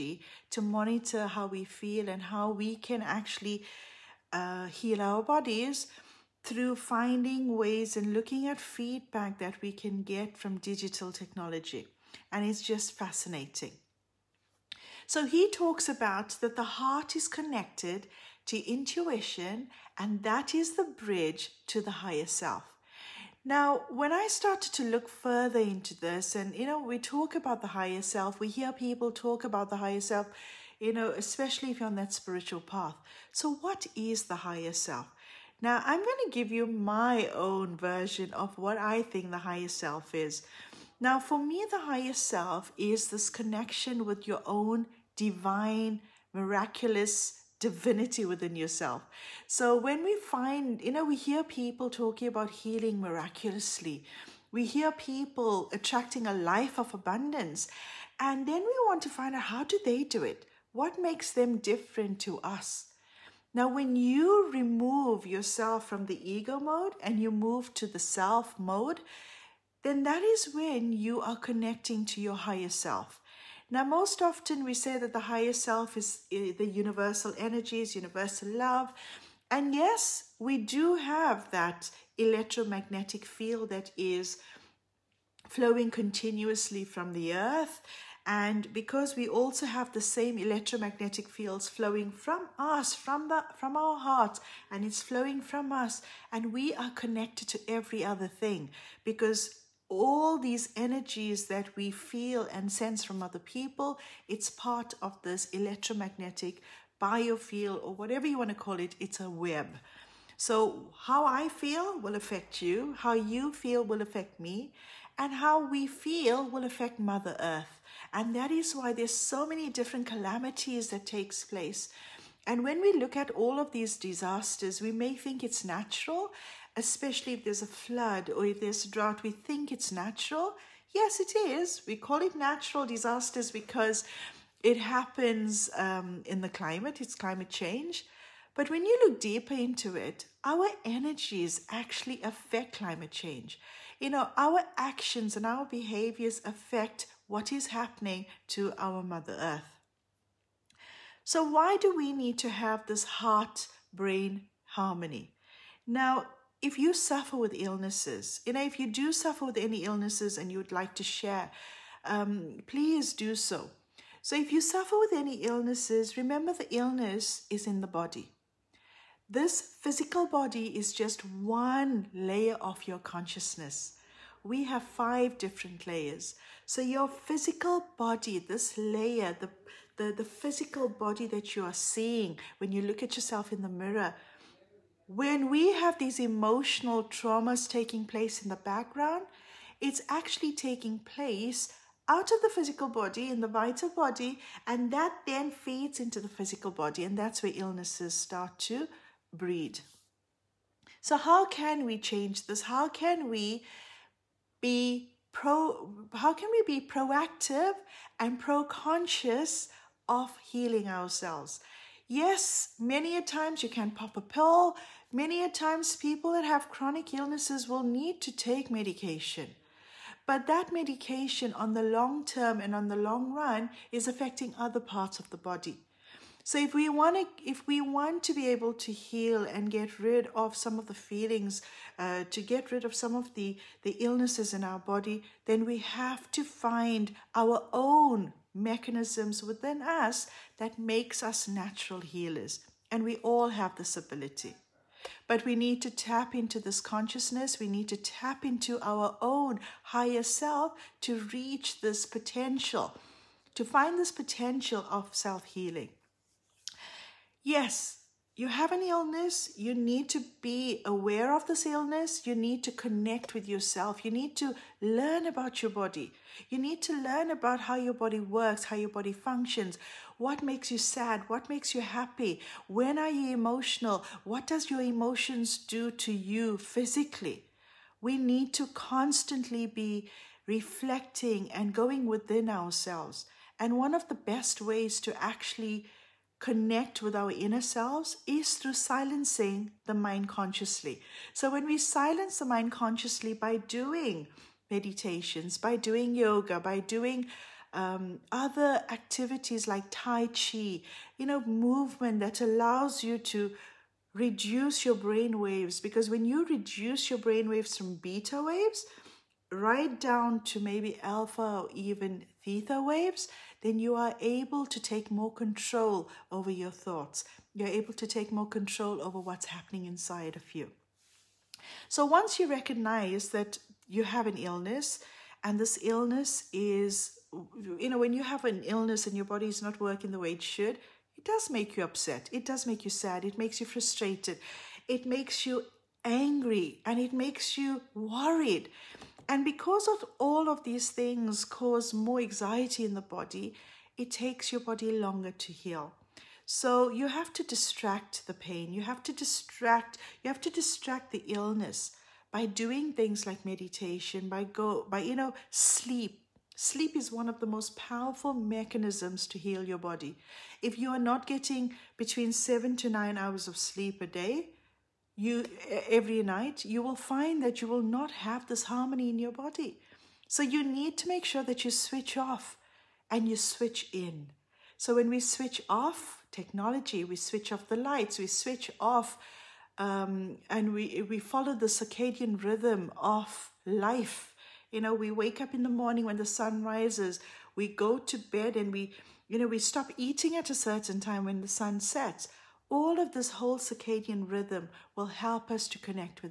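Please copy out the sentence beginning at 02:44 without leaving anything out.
So, if you suffer with any illnesses, remember the illness is in the body.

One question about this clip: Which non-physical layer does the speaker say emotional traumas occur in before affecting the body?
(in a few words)
Vital body.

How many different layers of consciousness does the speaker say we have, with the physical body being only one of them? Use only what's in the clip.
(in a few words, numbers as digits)
5.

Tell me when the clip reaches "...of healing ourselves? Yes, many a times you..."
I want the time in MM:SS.
03:30.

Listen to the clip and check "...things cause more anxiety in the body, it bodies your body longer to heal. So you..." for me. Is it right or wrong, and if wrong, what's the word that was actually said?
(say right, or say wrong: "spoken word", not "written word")
wrong: "takes", not "bodies".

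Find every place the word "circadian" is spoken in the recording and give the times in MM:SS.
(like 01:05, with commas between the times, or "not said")
06:21, 06:33.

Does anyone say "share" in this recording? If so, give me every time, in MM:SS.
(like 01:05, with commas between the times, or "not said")
02:41.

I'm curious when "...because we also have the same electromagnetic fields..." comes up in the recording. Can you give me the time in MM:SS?
01:28.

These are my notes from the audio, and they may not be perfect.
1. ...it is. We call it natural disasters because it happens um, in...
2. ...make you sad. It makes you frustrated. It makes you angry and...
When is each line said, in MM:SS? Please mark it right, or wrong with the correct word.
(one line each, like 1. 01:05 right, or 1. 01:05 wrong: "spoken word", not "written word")
1. 02:11 right
2. 05:32 right.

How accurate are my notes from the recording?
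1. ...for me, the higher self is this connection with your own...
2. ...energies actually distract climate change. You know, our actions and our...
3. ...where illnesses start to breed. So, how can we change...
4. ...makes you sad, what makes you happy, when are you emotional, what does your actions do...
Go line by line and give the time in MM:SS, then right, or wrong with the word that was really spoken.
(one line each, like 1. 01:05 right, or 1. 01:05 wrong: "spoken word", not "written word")
1. 00:41 right
2. 02:20 wrong: "affect", not "distract"
3. 03:17 right
4. 04:30 wrong: "emotions", not "actions".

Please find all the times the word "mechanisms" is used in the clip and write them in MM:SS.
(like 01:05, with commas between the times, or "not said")
03:58, 05:58.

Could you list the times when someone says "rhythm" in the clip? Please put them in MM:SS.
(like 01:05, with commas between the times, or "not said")
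06:22, 06:34.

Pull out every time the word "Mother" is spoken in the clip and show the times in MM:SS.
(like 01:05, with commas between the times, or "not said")
01:56, 02:29.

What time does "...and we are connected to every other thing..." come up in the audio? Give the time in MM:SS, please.
01:36.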